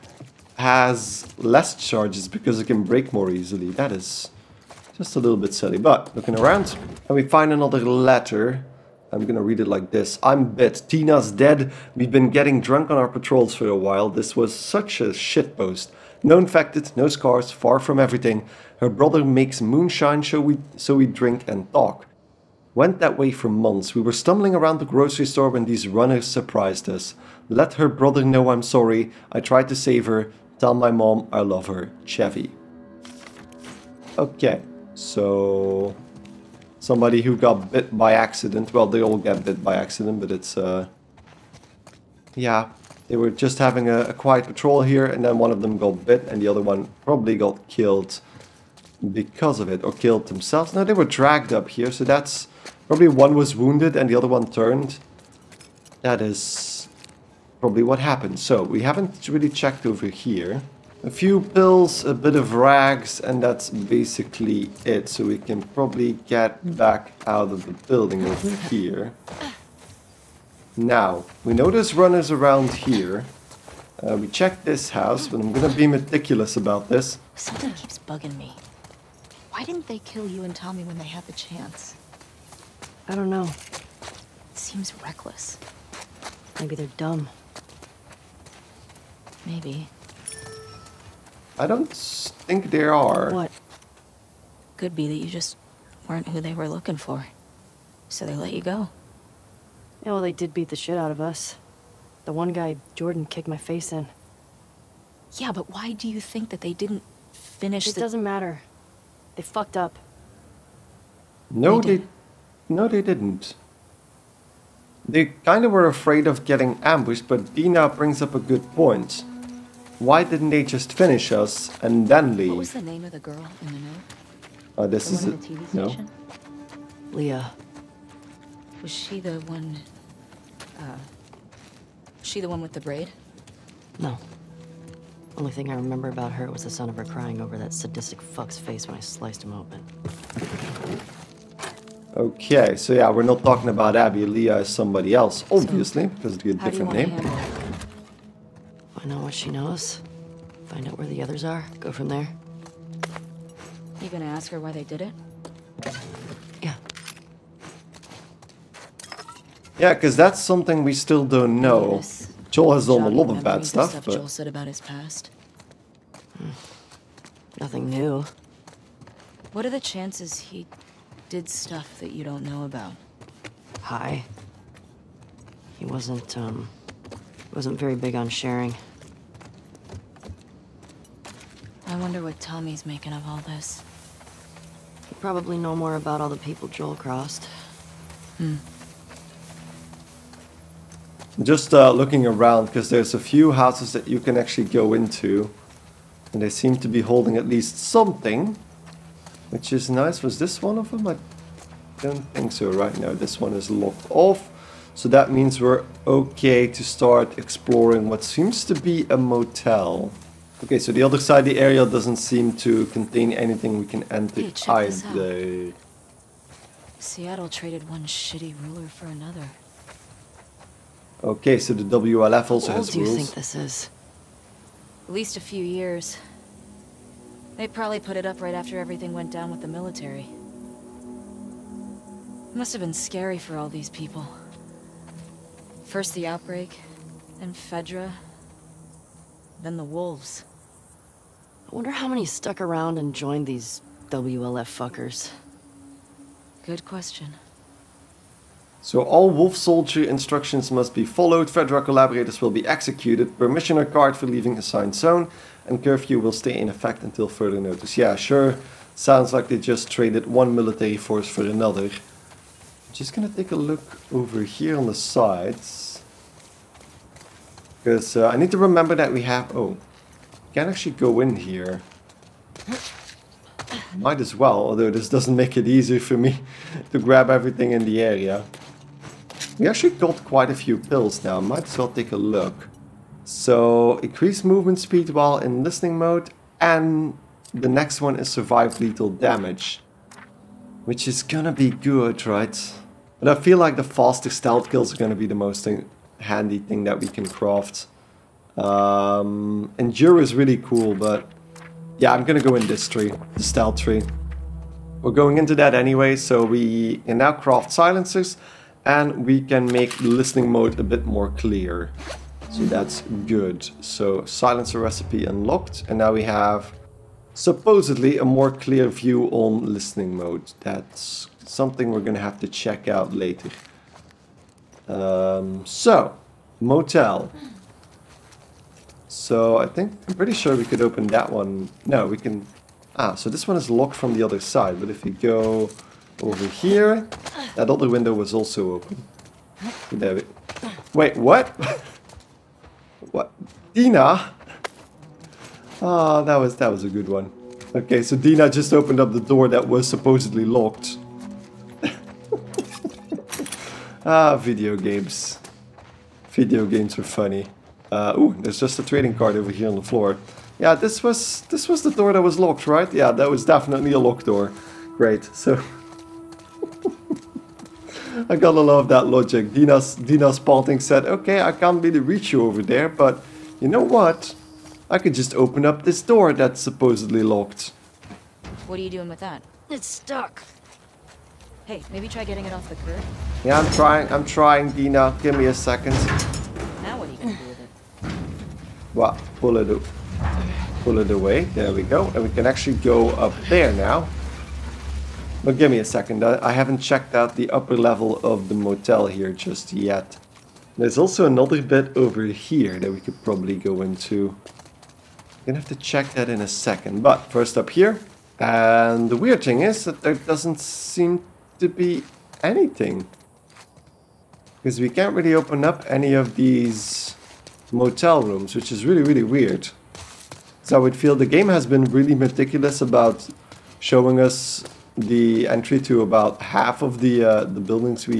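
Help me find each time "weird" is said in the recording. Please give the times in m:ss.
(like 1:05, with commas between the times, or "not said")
6:49, 6:59.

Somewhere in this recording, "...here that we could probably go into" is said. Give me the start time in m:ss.
6:42.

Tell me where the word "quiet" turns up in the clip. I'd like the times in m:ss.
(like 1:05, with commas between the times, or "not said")
0:44.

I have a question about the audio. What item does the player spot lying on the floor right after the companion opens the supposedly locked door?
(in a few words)
Trading card.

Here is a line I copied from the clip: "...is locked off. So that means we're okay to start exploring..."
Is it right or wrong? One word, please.
right.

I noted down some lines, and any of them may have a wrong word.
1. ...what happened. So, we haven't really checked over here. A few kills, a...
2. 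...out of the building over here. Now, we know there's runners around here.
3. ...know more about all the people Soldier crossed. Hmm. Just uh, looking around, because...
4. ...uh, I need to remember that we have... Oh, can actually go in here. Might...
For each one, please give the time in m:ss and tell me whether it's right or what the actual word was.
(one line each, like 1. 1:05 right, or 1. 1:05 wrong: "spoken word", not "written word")
1. 0:57 wrong: "pills", not "kills"
2. 1:07 right
3. 3:05 wrong: "Joel", not "Soldier"
4. 4:28 right.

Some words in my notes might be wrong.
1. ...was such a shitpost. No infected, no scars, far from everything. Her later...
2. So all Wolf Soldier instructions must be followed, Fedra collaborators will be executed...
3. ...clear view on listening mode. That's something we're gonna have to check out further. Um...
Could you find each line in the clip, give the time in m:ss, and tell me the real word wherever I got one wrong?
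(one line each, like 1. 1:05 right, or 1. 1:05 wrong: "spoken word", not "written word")
1. 0:14 wrong: "brother", not "later"
2. 4:08 right
3. 5:18 wrong: "later", not "further".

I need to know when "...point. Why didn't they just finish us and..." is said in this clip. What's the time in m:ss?
1:58.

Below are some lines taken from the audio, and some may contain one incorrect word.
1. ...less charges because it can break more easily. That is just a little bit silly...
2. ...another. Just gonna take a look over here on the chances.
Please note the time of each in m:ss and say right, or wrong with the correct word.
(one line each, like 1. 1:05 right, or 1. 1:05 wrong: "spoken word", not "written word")
1. 0:01 right
2. 4:21 wrong: "sides", not "chances".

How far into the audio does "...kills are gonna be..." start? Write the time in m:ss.
4:54.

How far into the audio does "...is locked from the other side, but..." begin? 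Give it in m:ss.
5:33.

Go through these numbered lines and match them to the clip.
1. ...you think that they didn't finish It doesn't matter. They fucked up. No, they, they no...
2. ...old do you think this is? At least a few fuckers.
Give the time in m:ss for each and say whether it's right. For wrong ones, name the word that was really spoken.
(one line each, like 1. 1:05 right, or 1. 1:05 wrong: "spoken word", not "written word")
1. 1:46 right
2. 3:42 wrong: "years", not "fuckers".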